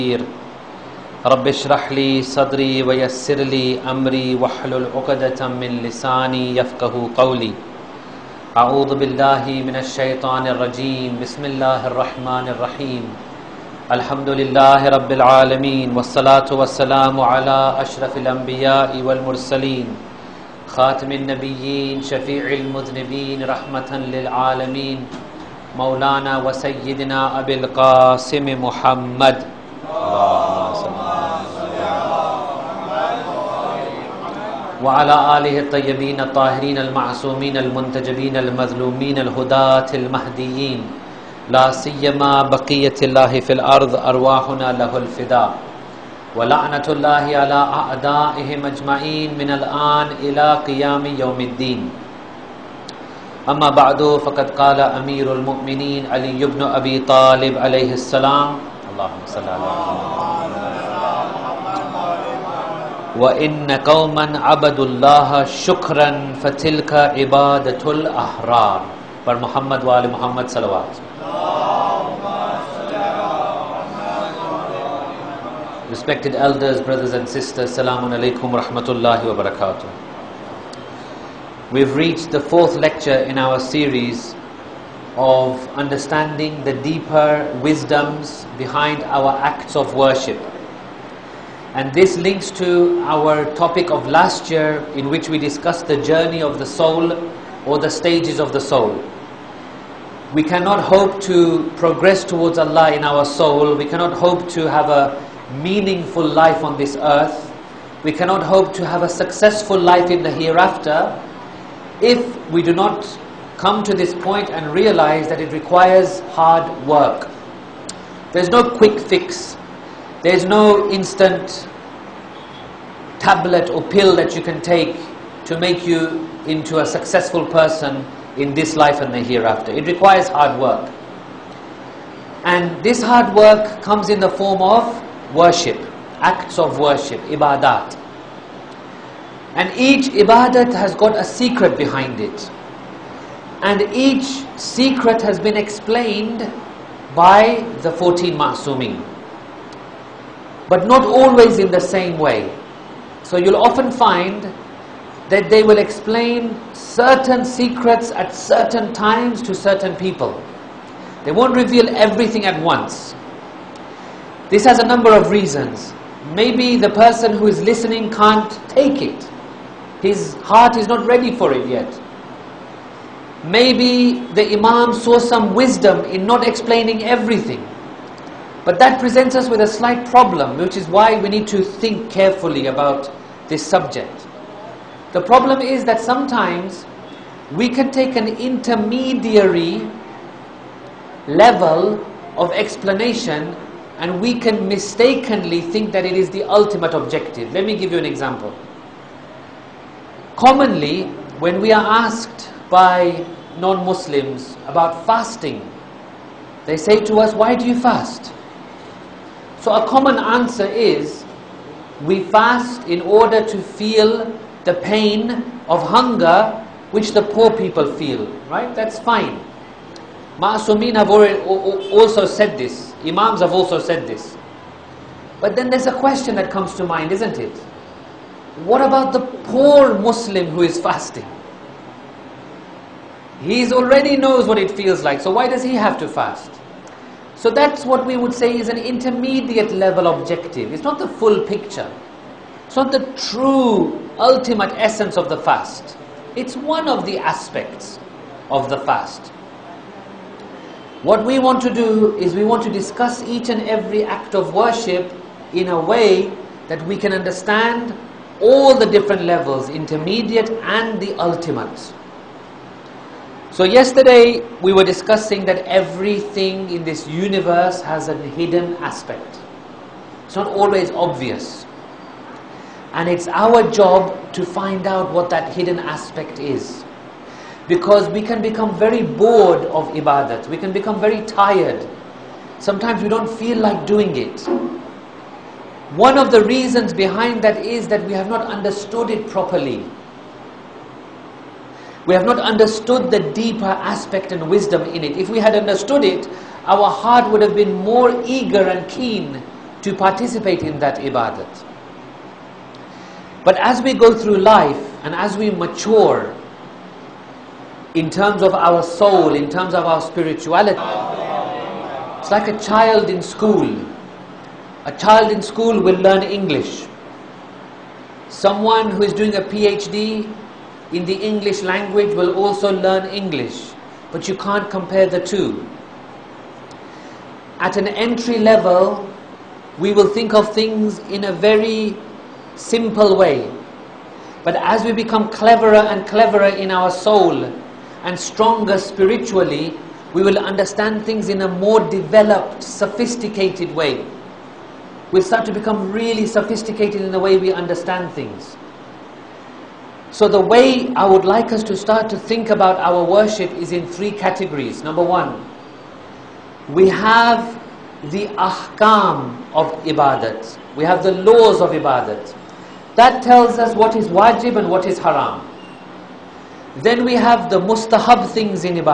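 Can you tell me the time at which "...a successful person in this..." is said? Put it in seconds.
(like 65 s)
126 s.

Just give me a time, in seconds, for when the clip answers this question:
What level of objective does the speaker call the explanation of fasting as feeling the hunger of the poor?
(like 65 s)
238 s.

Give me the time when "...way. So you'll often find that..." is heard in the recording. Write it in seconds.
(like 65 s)
152 s.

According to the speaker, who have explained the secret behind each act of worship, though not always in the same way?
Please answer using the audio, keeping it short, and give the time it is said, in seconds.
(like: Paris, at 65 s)
14 Ma'sumin, at 147 s.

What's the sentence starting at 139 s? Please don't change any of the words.
And each ibadat has got a secret behind it.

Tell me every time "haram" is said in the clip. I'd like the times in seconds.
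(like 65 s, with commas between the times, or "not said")
364 s.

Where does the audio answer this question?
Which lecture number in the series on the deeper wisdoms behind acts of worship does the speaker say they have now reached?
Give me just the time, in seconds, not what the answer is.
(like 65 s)
82 s.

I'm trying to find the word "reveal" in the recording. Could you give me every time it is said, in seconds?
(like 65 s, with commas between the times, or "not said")
161 s.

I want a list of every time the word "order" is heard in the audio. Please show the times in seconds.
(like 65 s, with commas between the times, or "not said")
213 s.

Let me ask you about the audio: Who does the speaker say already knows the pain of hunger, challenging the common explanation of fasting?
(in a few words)
poor Muslim.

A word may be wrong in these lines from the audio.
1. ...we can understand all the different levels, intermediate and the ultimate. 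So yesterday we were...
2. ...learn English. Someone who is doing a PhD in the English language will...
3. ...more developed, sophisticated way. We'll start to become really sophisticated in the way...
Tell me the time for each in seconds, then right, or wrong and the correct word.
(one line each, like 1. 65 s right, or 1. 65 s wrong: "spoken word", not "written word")
1. 256 s right
2. 316 s right
3. 341 s right.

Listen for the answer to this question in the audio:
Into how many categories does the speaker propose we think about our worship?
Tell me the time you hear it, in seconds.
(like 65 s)
353 s.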